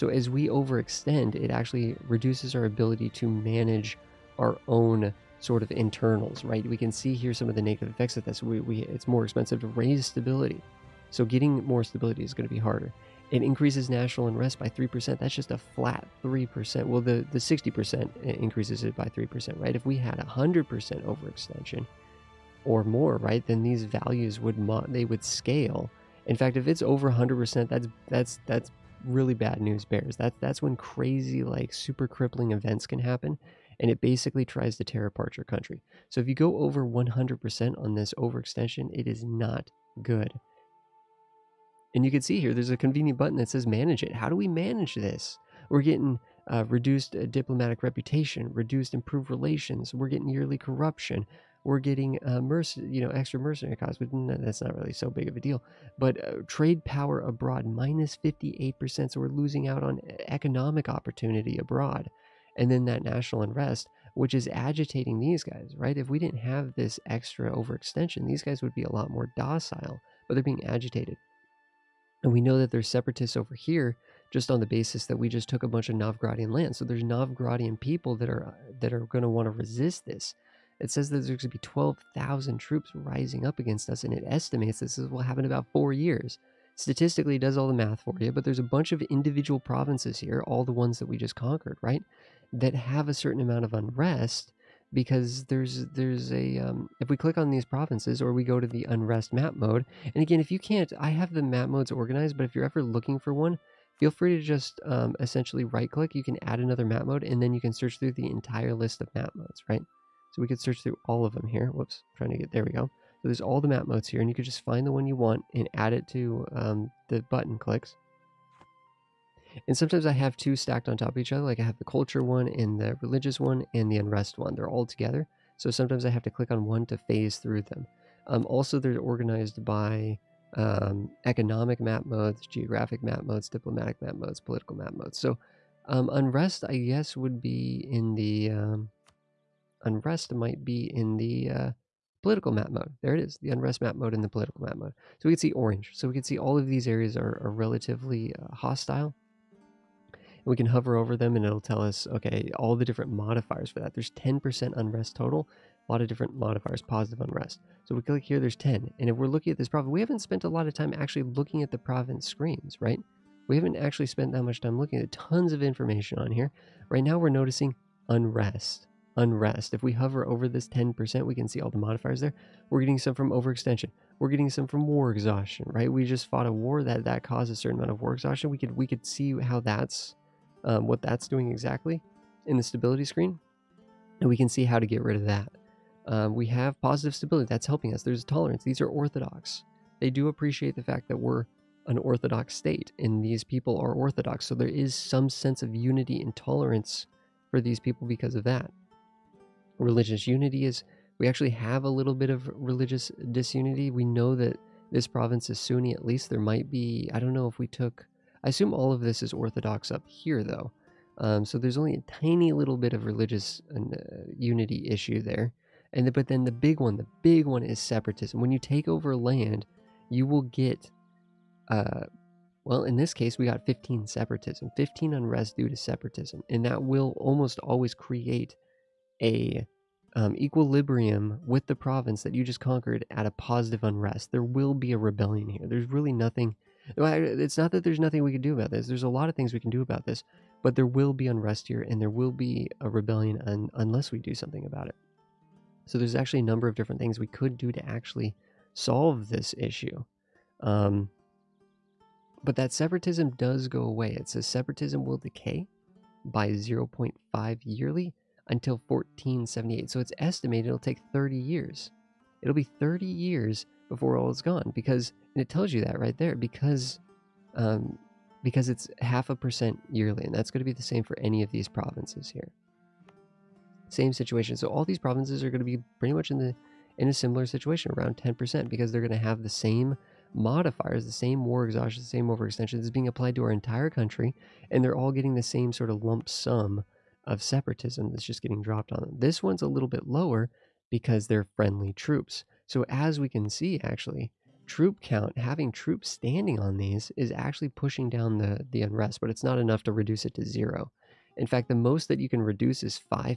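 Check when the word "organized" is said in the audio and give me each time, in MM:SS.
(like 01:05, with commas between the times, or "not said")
01:41, 02:08.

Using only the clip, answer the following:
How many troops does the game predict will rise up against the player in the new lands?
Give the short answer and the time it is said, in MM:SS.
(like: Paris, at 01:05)
12,000, at 01:21.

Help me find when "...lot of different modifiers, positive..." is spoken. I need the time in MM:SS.
02:35.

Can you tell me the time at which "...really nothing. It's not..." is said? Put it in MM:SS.
03:55.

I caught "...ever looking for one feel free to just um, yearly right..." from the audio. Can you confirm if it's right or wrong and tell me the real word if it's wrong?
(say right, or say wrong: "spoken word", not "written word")
wrong: "essentially", not "yearly".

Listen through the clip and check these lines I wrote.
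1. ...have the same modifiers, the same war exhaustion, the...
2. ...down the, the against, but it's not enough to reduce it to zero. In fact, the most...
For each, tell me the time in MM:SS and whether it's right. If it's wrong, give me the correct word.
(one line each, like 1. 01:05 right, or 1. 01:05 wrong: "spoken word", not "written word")
1. 04:39 right
2. 04:58 wrong: "unrest", not "against".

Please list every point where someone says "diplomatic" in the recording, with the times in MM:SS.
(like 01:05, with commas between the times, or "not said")
00:47, 02:13.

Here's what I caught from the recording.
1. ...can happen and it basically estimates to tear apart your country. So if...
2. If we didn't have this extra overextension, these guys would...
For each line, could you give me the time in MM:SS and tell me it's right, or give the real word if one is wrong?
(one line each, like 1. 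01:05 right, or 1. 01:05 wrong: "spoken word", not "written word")
1. 00:32 wrong: "tries", not "estimates"
2. 01:05 right.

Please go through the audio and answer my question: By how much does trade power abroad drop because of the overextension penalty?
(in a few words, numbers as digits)
58%.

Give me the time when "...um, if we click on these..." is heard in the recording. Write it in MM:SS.
01:36.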